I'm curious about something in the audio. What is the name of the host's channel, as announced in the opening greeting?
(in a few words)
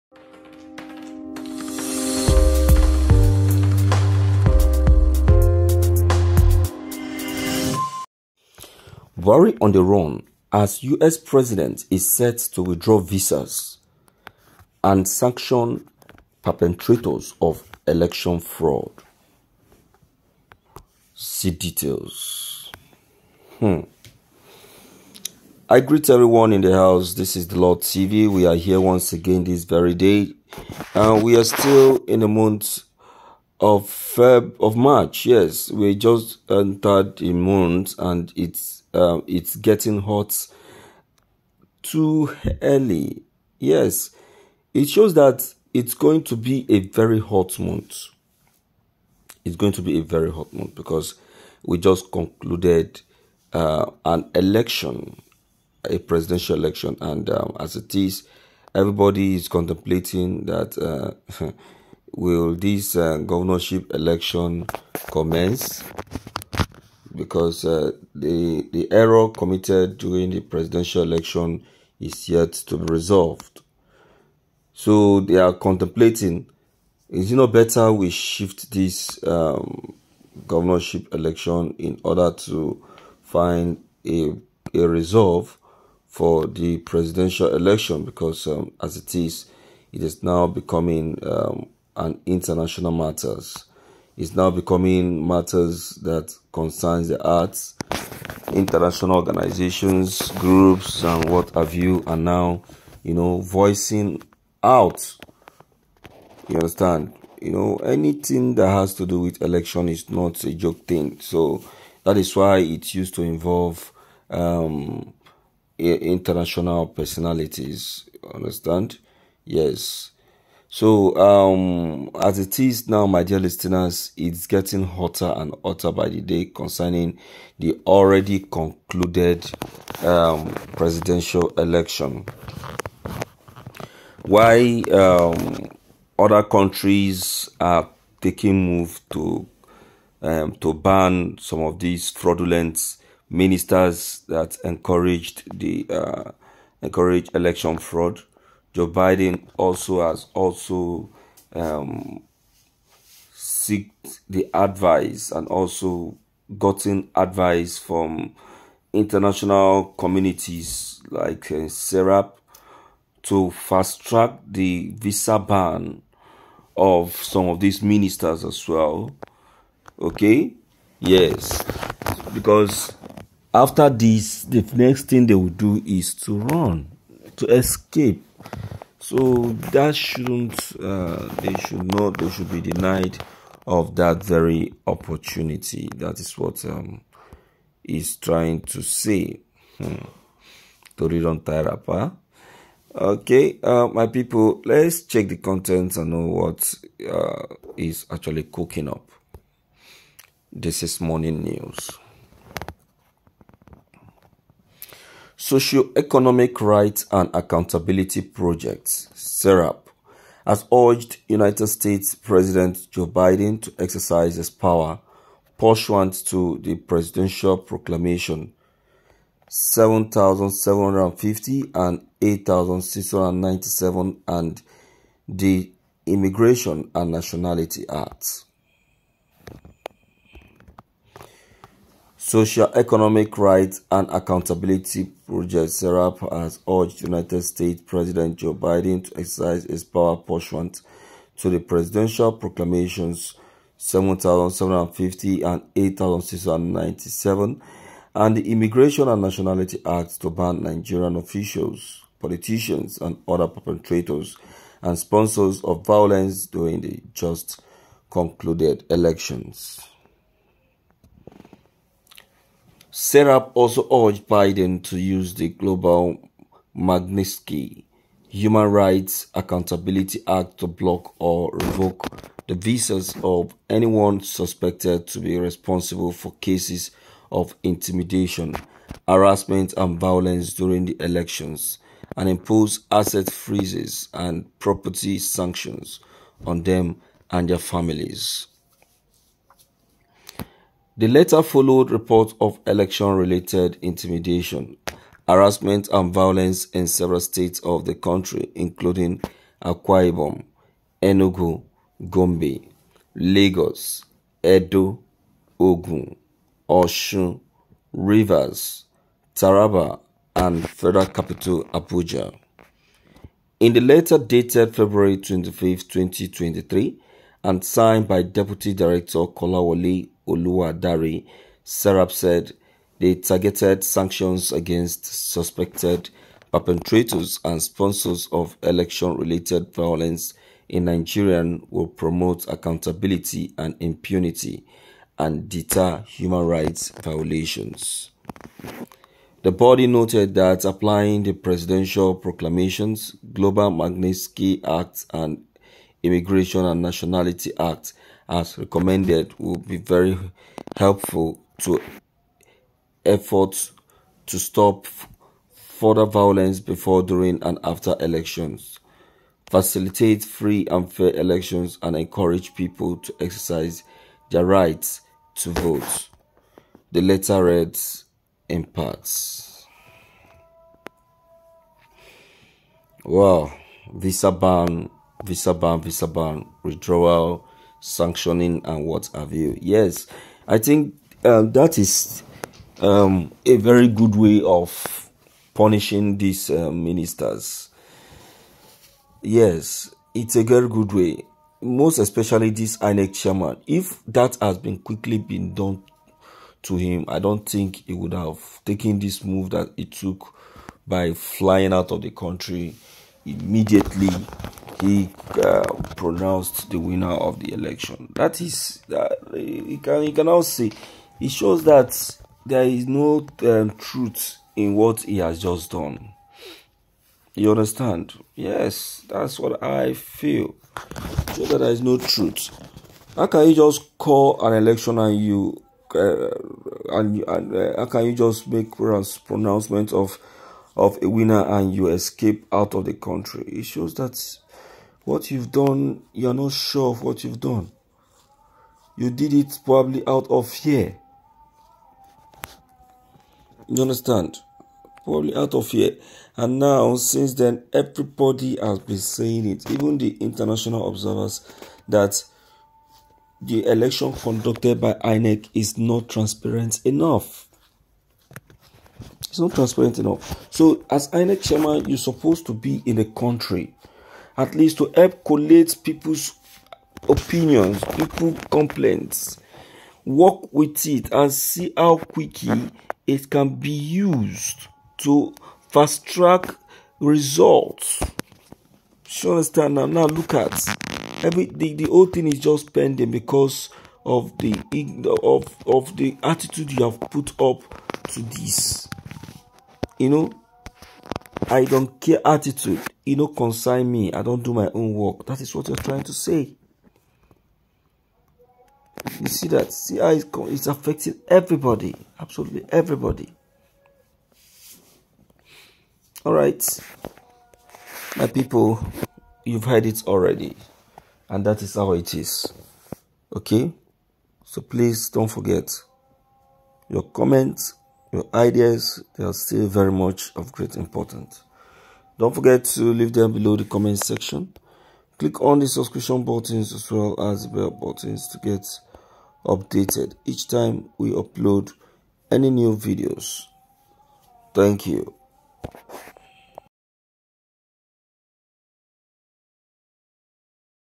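Dlaw TV.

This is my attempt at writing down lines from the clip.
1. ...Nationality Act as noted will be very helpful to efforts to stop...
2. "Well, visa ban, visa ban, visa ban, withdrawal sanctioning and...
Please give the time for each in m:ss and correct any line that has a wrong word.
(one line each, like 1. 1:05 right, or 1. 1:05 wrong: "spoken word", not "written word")
1. 5:46 wrong: "recommended", not "noted"
2. 6:13 right.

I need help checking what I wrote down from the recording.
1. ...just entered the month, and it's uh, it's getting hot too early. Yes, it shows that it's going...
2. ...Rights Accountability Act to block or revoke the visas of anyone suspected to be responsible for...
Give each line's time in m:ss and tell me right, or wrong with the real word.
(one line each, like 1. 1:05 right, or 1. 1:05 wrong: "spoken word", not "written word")
1. 0:35 right
2. 4:28 right.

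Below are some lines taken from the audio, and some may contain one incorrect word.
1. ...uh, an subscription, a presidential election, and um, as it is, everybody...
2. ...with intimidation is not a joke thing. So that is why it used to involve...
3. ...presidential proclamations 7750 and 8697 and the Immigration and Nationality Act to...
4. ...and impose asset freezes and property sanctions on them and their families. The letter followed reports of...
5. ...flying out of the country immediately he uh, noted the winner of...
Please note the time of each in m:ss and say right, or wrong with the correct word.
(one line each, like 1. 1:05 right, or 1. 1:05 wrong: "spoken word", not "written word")
1. 0:53 wrong: "election", not "subscription"
2. 1:49 wrong: "election", not "intimidation"
3. 4:01 right
4. 4:42 right
5. 6:41 wrong: "pronounced", not "noted".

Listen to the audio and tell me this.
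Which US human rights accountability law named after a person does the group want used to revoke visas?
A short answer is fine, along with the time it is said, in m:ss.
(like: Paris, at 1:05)
Global Magnitsky Human Rights Accountability Act, at 4:25.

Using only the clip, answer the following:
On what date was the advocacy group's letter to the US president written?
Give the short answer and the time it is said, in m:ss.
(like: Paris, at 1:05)
February 25, 2023, at 5:14.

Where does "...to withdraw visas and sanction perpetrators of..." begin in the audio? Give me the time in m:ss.
0:12.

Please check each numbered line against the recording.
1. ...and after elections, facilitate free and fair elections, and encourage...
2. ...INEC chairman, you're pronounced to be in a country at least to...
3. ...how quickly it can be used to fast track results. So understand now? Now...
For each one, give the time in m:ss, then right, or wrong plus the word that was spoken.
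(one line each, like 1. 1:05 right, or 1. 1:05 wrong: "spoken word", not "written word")
1. 5:57 right
2. 7:41 wrong: "supposed", not "pronounced"
3. 7:51 right.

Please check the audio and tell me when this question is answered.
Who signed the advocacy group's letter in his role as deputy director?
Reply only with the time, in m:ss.
5:19.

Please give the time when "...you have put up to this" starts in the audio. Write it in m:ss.
8:06.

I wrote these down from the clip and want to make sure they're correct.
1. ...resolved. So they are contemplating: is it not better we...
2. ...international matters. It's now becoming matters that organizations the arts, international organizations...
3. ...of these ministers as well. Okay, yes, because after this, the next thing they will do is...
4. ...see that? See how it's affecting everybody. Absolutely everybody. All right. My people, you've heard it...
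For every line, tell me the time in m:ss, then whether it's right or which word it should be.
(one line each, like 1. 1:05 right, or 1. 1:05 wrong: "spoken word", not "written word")
1. 1:12 right
2. 1:32 wrong: "concerns", not "organizations"
3. 2:47 right
4. 8:19 right.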